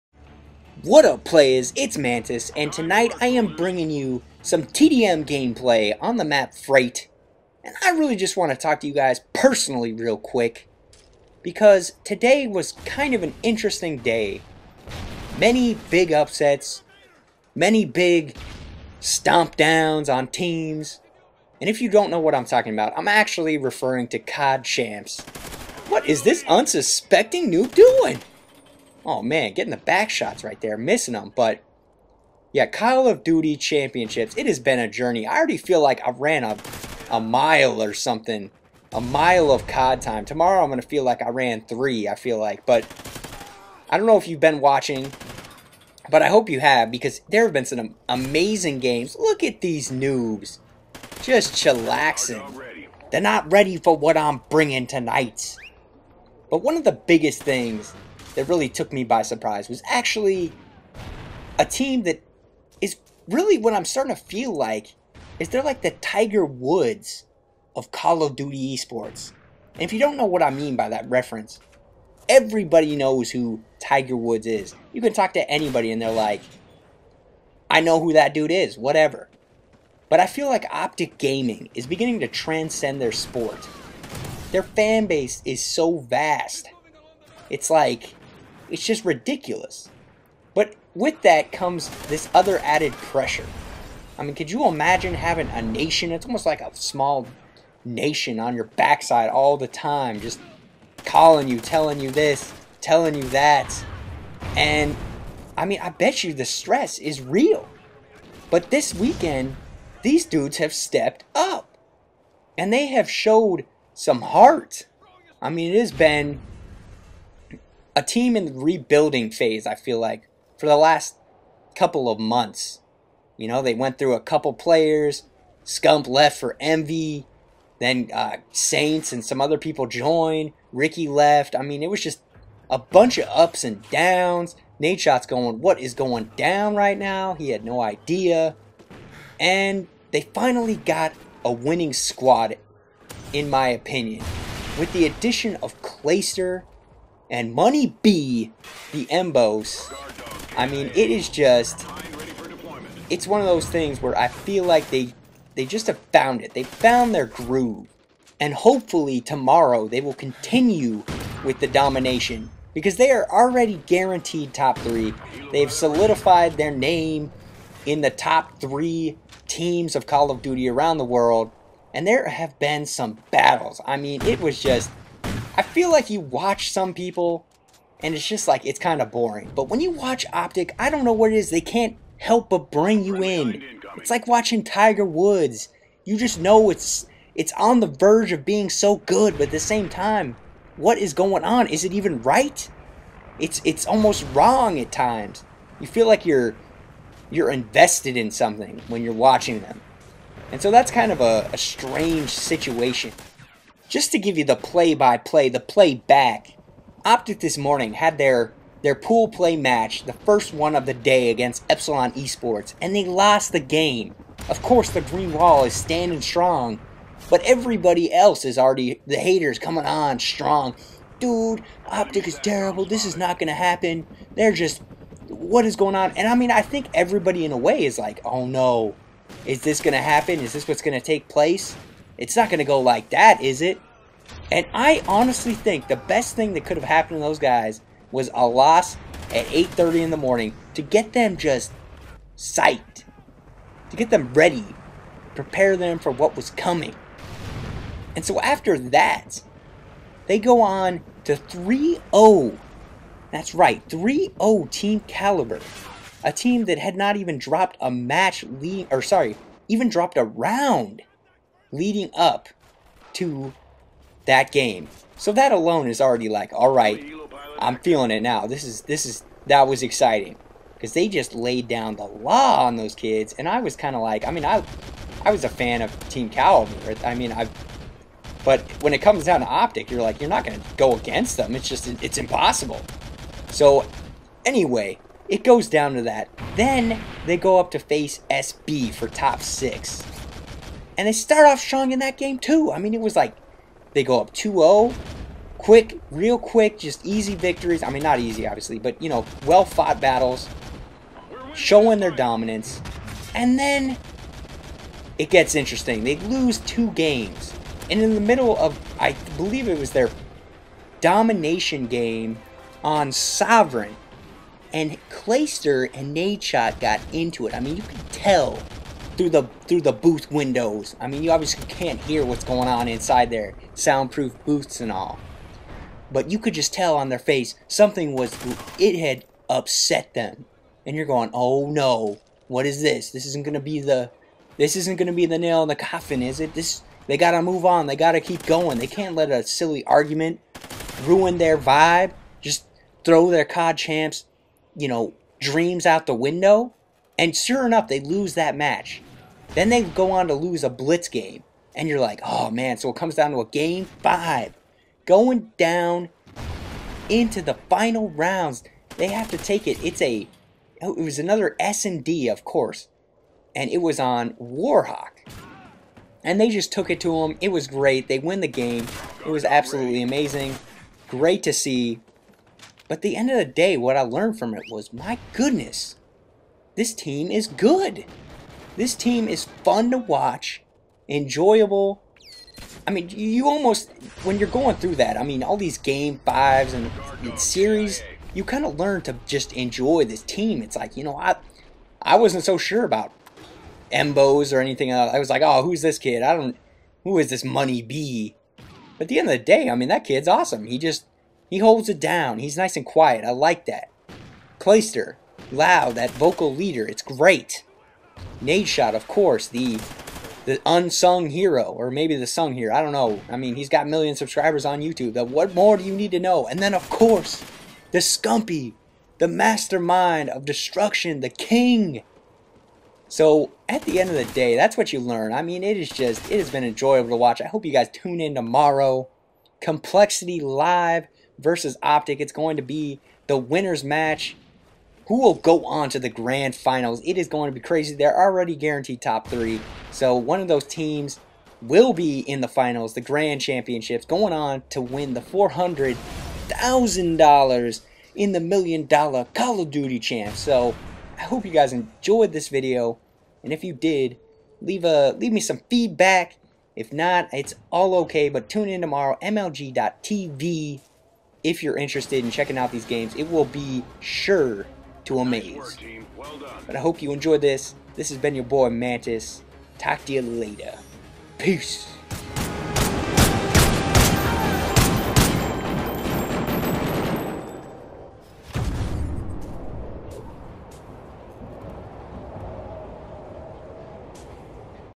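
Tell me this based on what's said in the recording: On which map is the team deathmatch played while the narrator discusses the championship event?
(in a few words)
Freight.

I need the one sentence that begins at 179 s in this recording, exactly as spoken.
But when you watch Optic, I don't know what it is.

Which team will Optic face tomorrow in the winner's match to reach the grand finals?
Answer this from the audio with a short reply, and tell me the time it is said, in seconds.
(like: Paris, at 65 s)
Complexity Live, at 429 s.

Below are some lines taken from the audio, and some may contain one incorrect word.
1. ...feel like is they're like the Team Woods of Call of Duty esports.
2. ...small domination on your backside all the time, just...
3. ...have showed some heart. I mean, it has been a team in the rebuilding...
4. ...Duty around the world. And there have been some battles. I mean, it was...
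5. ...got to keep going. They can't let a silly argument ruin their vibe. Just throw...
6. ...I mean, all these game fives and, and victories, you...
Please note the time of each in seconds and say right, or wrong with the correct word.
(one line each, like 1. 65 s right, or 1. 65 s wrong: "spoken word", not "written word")
1. 64 s wrong: "Tiger", not "Team"
2. 96 s wrong: "nation", not "domination"
3. 112 s right
4. 170 s right
5. 337 s right
6. 385 s wrong: "series", not "victories".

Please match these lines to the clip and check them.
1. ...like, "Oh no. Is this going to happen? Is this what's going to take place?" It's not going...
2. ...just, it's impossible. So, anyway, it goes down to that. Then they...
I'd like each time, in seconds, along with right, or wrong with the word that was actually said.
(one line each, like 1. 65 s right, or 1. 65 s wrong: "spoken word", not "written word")
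1. 227 s right
2. 281 s right.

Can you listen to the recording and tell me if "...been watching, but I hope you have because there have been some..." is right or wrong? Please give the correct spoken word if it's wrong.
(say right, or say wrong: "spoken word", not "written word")
right.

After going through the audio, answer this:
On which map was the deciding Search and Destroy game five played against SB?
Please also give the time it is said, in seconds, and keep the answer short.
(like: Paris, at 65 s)
Warhawk, at 364 s.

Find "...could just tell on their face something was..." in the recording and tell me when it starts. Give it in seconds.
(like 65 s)
326 s.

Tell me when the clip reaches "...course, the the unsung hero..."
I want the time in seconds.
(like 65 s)
409 s.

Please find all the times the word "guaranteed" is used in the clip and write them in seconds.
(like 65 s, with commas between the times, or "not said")
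163 s, 438 s.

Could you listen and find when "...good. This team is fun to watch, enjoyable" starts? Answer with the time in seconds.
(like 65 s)
377 s.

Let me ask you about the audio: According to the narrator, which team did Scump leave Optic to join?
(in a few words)
Envy.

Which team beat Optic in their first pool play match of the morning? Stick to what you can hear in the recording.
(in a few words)
Epsilon Esports.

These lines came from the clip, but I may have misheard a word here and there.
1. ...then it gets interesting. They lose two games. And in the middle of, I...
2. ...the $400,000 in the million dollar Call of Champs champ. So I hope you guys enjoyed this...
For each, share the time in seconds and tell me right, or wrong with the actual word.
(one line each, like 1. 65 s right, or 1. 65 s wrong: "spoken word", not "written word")
1. 303 s right
2. 445 s wrong: "Duty", not "Champs".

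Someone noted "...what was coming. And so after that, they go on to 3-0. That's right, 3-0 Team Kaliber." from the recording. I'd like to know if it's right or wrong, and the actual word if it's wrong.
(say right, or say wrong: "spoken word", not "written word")
right.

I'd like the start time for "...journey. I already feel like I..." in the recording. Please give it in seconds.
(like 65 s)
34 s.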